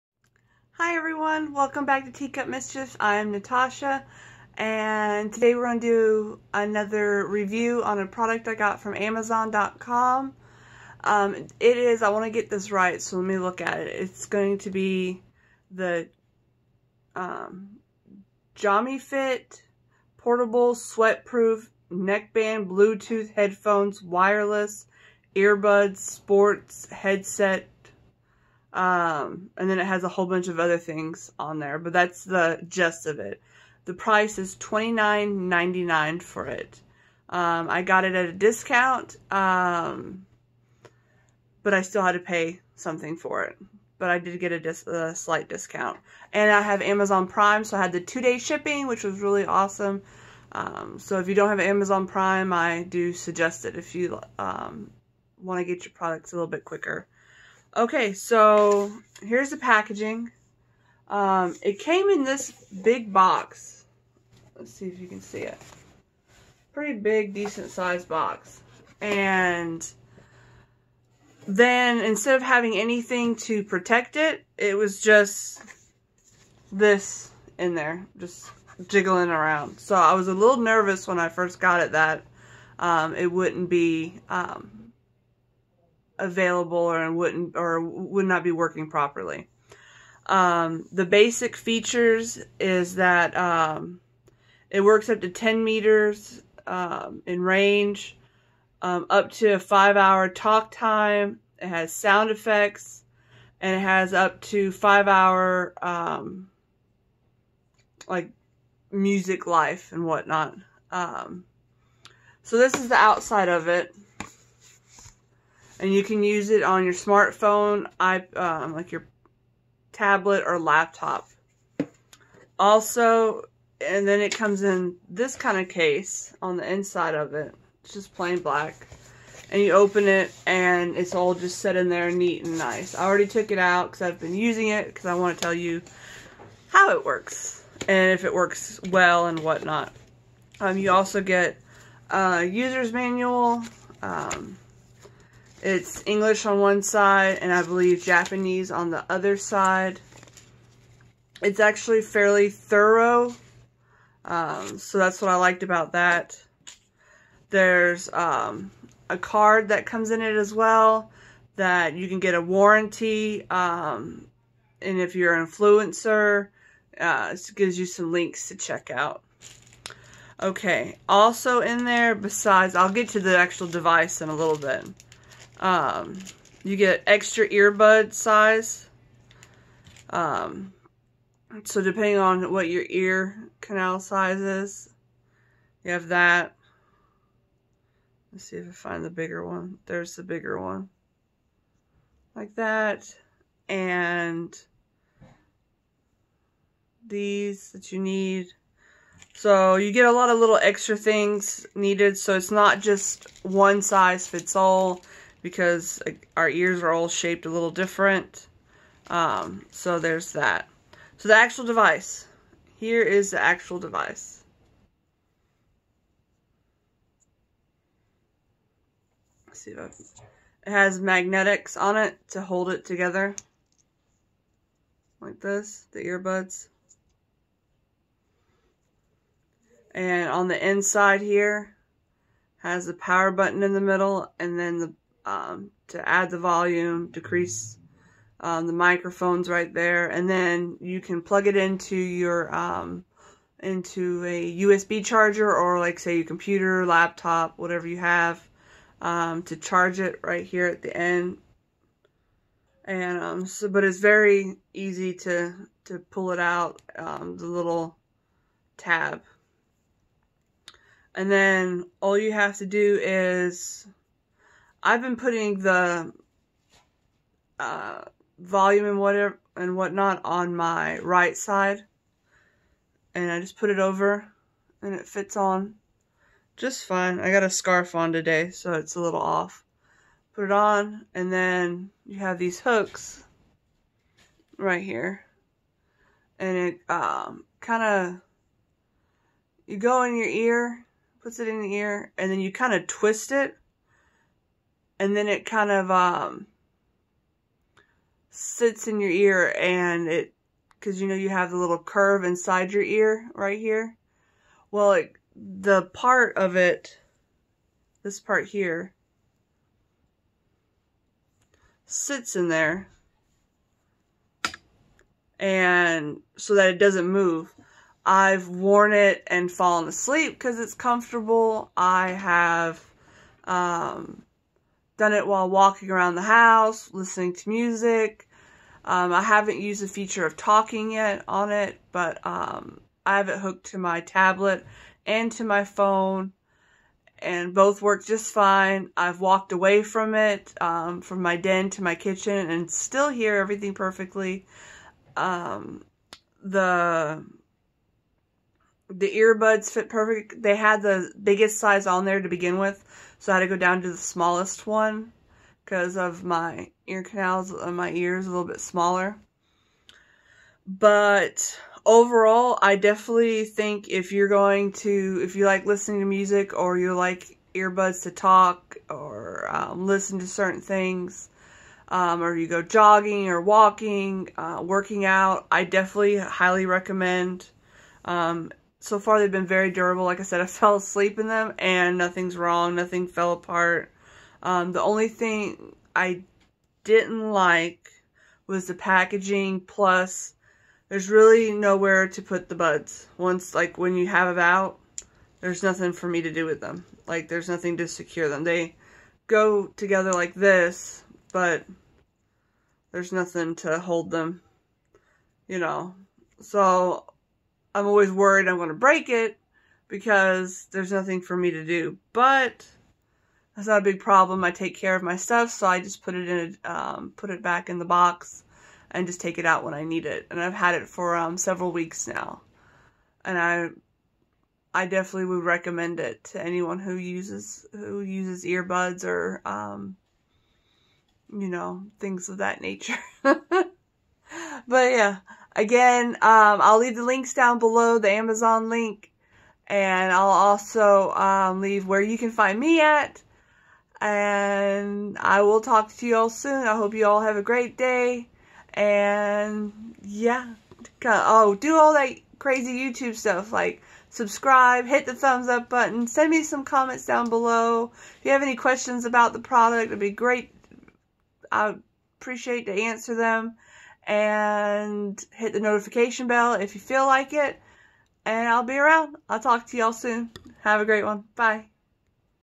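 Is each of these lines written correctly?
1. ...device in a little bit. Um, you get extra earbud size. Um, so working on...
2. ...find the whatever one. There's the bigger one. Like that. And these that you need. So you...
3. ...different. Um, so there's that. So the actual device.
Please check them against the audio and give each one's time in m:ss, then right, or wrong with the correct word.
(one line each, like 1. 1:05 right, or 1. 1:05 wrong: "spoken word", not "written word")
1. 2:53 wrong: "depending", not "working"
2. 3:08 wrong: "bigger", not "whatever"
3. 3:27 right.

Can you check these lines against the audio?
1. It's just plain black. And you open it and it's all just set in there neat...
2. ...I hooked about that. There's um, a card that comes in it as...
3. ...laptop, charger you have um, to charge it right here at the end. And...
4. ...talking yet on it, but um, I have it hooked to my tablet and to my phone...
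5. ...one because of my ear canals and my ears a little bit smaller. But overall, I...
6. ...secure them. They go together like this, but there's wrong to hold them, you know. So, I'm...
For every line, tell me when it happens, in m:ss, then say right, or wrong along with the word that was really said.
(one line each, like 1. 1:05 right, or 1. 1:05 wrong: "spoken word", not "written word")
1. 2:07 right
2. 2:35 wrong: "liked", not "hooked"
3. 4:06 wrong: "whatever", not "charger"
4. 5:30 right
5. 5:54 right
6. 6:37 wrong: "nothing", not "wrong".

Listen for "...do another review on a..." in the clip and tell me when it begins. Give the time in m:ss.
0:05.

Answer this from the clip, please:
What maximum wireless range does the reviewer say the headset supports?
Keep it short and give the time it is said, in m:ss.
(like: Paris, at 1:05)
10 meters, at 1:35.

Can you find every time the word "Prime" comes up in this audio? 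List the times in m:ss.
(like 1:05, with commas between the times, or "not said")
0:47, 0:52.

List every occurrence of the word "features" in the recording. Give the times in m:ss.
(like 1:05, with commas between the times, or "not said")
1:31, 5:29.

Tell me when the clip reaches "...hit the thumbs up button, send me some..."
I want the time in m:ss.
7:34.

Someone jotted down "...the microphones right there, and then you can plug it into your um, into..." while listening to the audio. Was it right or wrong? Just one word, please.
right.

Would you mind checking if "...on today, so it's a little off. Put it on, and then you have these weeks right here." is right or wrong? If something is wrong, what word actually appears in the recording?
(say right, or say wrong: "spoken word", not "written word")
wrong: "hooks", not "weeks".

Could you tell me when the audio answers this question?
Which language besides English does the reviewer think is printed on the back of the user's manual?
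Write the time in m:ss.
2:28.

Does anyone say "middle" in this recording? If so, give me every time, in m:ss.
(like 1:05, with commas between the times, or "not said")
3:53.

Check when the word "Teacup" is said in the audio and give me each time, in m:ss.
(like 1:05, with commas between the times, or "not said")
0:02.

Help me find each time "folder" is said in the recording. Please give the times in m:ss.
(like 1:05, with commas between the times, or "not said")
not said.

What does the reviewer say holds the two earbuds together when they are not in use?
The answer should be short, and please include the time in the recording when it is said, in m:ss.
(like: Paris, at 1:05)
Magnetics, at 3:40.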